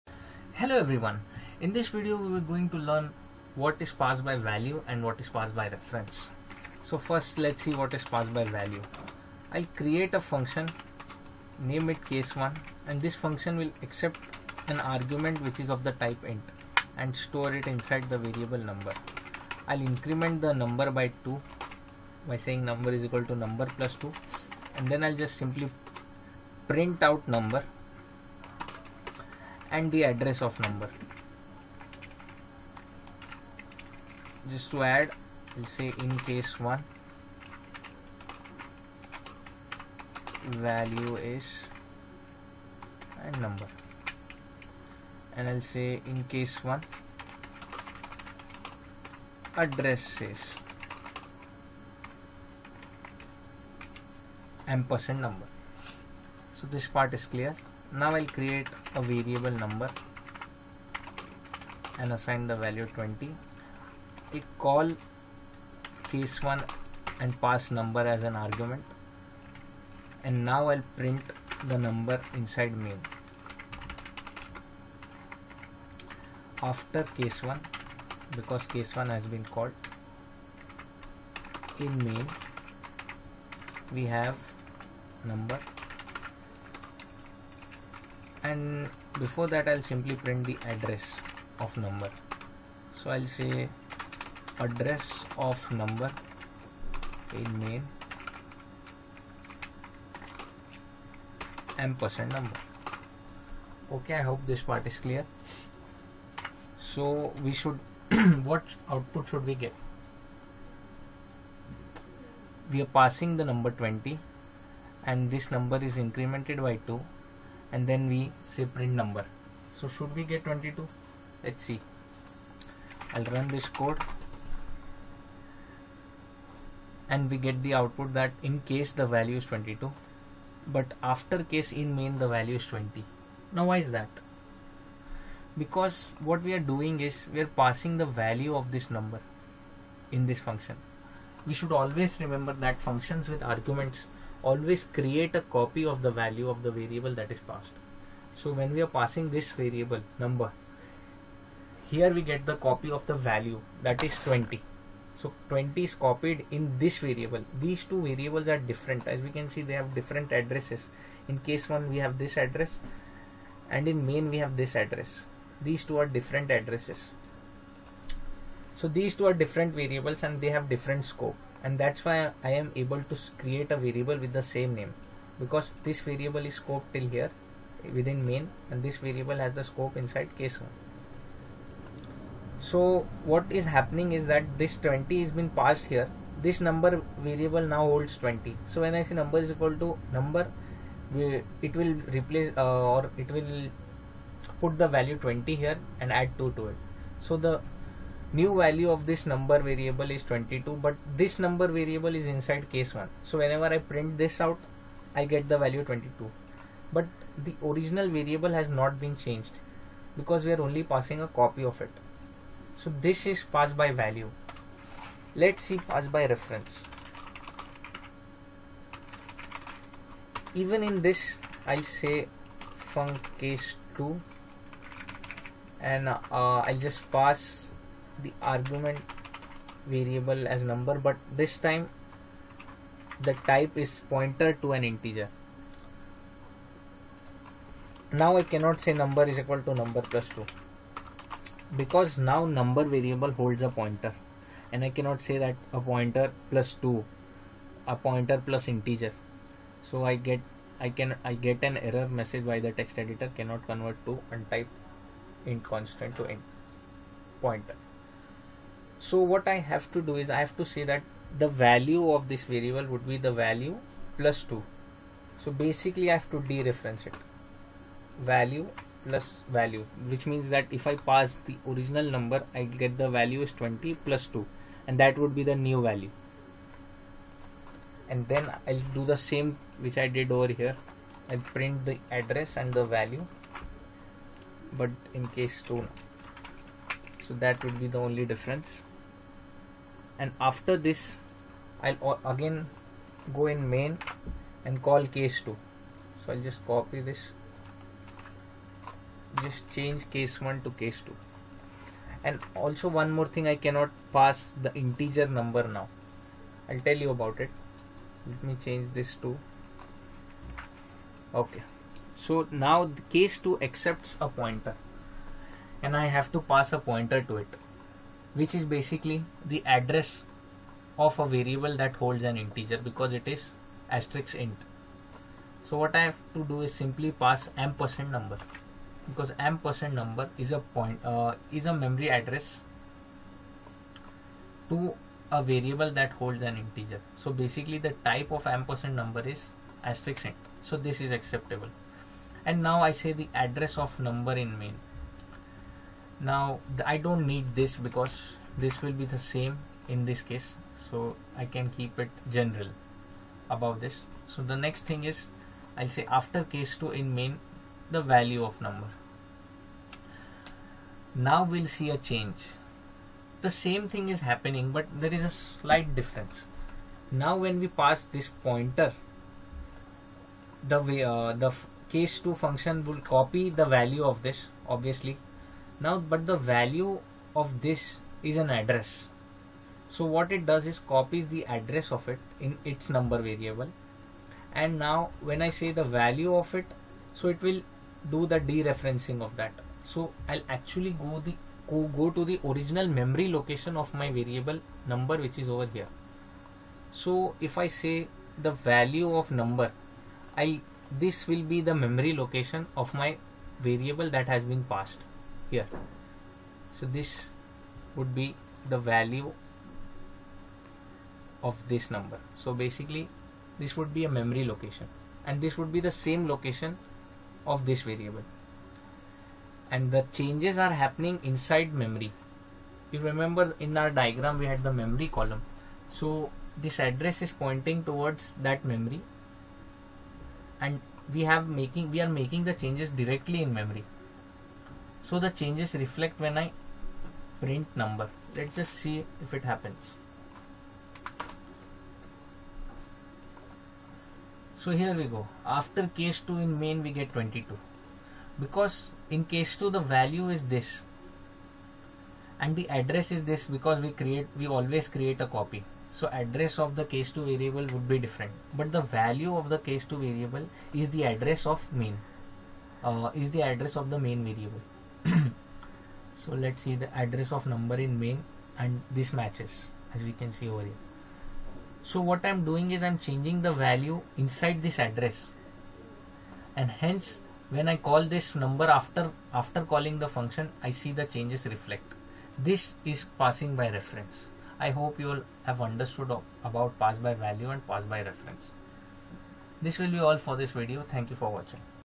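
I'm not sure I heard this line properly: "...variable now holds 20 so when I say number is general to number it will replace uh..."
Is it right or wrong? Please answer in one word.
wrong.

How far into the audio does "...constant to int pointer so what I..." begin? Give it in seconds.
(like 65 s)
255 s.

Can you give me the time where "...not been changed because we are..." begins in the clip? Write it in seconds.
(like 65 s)
208 s.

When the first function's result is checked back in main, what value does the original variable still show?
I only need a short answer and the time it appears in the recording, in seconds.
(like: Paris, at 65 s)
20, at 131 s.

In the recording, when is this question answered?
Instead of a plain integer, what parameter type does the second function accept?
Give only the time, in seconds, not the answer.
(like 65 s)
234 s.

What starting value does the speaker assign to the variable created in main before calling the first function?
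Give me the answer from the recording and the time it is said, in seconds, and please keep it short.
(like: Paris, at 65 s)
20, at 62 s.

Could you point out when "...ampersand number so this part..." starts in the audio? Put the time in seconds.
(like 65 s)
54 s.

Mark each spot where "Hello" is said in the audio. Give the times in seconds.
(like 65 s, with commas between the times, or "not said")
0 s.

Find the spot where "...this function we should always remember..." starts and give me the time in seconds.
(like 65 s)
140 s.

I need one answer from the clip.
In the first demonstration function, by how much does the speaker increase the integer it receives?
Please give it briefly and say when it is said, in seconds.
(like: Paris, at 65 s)
2, at 116 s.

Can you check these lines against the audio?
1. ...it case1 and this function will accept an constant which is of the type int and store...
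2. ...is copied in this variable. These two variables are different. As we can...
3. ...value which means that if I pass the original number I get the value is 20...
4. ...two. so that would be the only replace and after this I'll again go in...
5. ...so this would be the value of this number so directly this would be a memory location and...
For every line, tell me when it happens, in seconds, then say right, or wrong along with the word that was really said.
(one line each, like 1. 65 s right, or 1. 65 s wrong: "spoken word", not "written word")
1. 11 s wrong: "argument", not "constant"
2. 155 s right
3. 269 s right
4. 285 s wrong: "difference", not "replace"
5. 406 s wrong: "basically", not "directly".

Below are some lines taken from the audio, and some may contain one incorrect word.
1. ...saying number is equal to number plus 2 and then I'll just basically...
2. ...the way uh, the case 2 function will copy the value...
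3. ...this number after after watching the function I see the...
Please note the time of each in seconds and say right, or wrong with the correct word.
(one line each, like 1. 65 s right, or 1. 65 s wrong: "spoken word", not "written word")
1. 22 s wrong: "simply", not "basically"
2. 370 s right
3. 478 s wrong: "calling", not "watching".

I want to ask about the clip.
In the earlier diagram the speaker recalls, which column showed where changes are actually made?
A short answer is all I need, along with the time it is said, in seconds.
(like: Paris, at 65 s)
memory column, at 424 s.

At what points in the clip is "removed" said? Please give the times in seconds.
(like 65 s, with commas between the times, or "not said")
not said.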